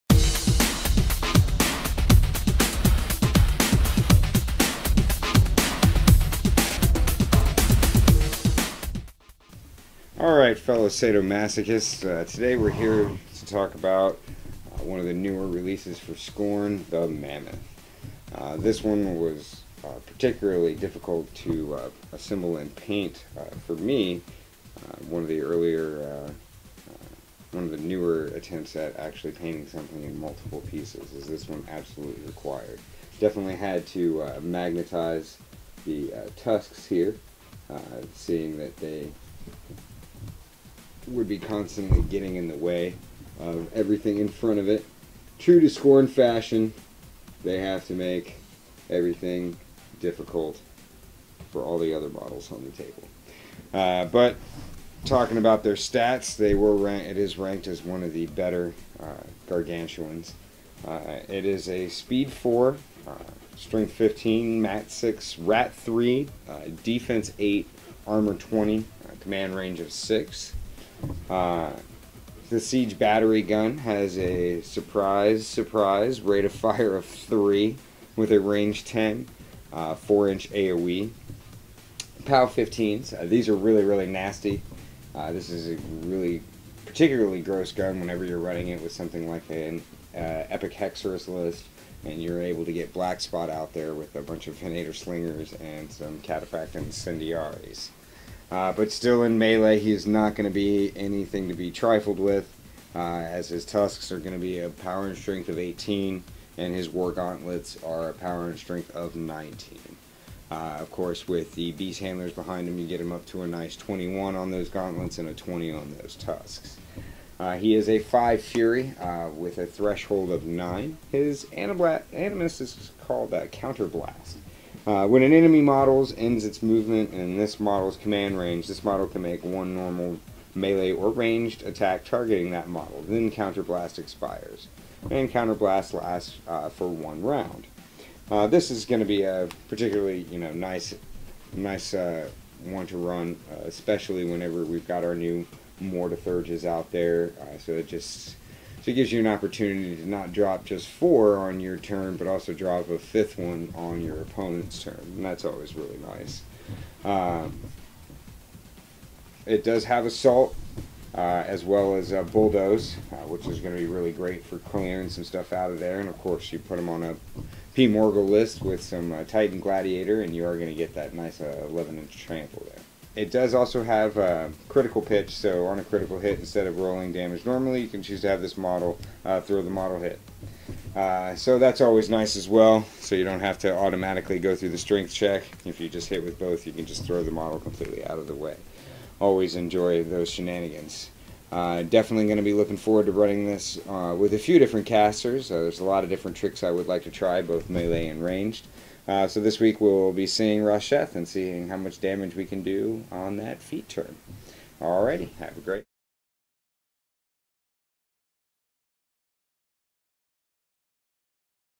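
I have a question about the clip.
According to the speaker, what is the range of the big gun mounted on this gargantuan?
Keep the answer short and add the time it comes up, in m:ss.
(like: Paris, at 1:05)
10, at 1:18.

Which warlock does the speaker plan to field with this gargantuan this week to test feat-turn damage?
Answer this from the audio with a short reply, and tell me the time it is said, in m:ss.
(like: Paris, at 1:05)
Rasheth, at 3:20.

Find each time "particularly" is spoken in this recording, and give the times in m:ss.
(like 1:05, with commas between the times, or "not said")
0:20, 1:26, 2:19.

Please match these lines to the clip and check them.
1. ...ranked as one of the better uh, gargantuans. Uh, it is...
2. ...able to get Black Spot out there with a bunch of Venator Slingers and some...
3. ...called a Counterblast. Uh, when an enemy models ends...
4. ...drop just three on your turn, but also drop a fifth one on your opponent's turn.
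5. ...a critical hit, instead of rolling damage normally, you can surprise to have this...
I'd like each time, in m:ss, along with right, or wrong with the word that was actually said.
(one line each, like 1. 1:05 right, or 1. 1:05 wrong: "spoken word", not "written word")
1. 0:57 right
2. 1:32 right
3. 2:03 right
4. 2:30 wrong: "four", not "three"
5. 2:55 wrong: "choose", not "surprise".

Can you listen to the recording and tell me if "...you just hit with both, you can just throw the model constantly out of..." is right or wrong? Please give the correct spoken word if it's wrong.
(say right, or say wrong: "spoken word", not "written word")
wrong: "completely", not "constantly".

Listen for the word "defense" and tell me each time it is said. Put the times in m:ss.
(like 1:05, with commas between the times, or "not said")
1:06.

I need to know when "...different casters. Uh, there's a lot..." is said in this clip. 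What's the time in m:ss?
3:14.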